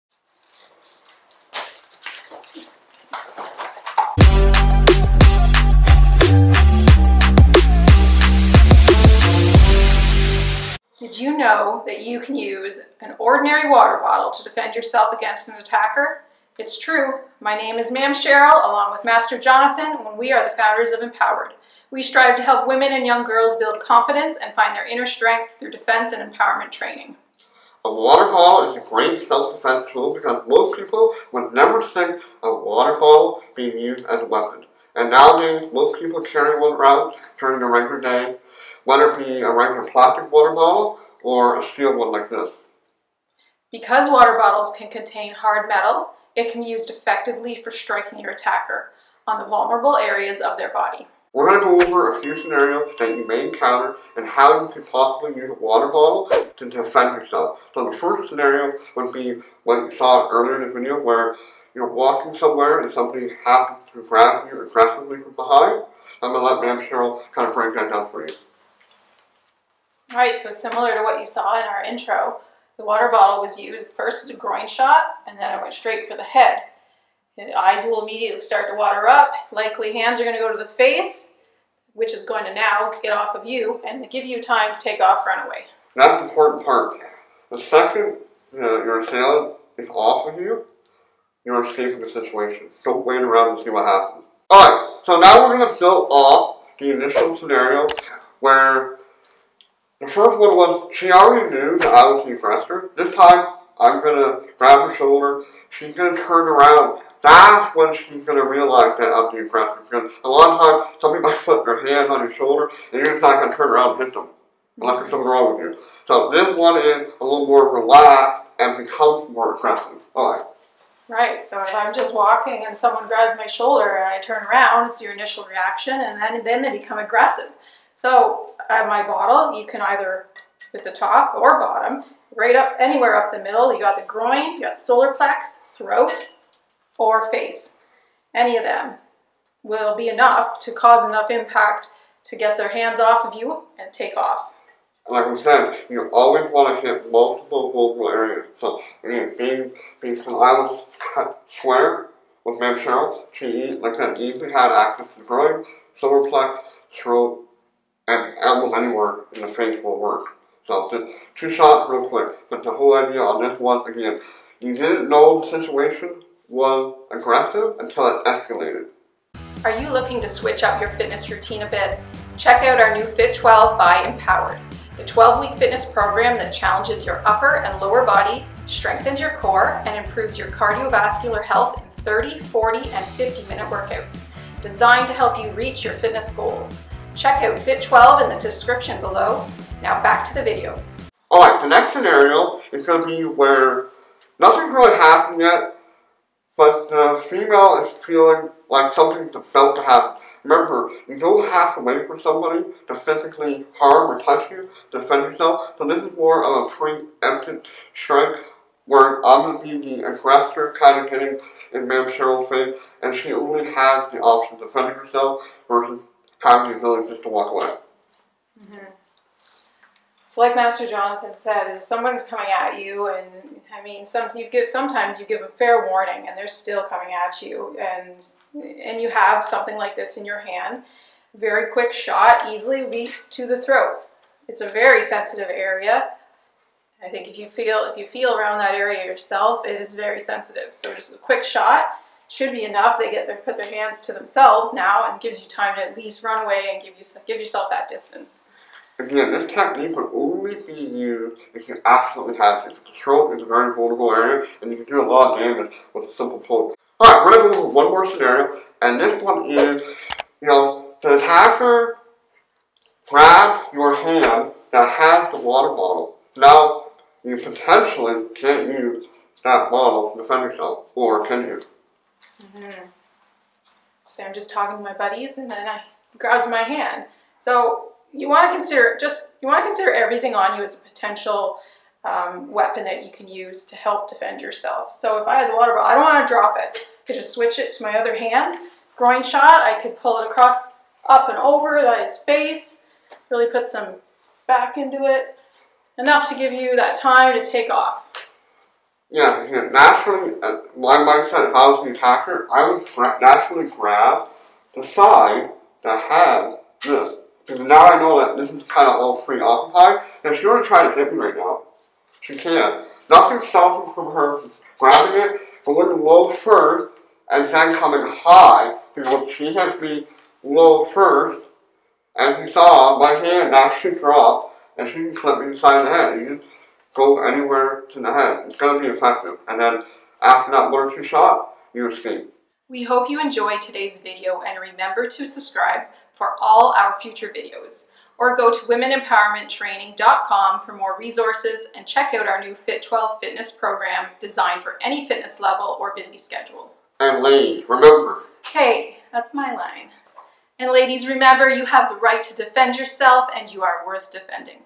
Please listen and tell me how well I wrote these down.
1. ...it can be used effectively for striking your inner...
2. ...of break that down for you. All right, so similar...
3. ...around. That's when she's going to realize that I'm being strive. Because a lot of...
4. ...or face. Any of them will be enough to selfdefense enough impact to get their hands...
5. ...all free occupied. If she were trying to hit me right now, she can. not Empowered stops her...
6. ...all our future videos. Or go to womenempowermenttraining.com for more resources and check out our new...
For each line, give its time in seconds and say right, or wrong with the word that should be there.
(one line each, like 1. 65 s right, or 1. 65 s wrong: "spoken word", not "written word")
1. 46 s wrong: "attacker", not "inner"
2. 67 s right
3. 106 s wrong: "aggressive", not "strive"
4. 136 s wrong: "cause", not "selfdefense"
5. 308 s wrong: "Nothing", not "Empowered"
6. 336 s right.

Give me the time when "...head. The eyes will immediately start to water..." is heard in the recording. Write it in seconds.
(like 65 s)
76 s.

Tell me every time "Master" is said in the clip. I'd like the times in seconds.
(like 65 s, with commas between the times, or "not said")
19 s, 220 s.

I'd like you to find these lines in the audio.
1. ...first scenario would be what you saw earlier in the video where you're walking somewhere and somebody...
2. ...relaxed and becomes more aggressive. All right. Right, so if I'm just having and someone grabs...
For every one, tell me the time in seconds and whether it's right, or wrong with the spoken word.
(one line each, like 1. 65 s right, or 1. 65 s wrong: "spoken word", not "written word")
1. 57 s right
2. 117 s wrong: "walking", not "having".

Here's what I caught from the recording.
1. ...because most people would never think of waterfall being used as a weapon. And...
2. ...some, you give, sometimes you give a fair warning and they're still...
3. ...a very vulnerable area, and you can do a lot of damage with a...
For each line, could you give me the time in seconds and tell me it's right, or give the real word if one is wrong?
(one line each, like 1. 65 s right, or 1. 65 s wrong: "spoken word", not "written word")
1. 30 s right
2. 224 s right
3. 253 s right.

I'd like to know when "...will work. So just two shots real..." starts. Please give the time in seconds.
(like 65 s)
159 s.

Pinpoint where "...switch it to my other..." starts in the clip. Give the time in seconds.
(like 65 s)
287 s.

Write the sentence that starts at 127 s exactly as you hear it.
So at my bottle, you can either with the top or bottom, right up anywhere up the middle.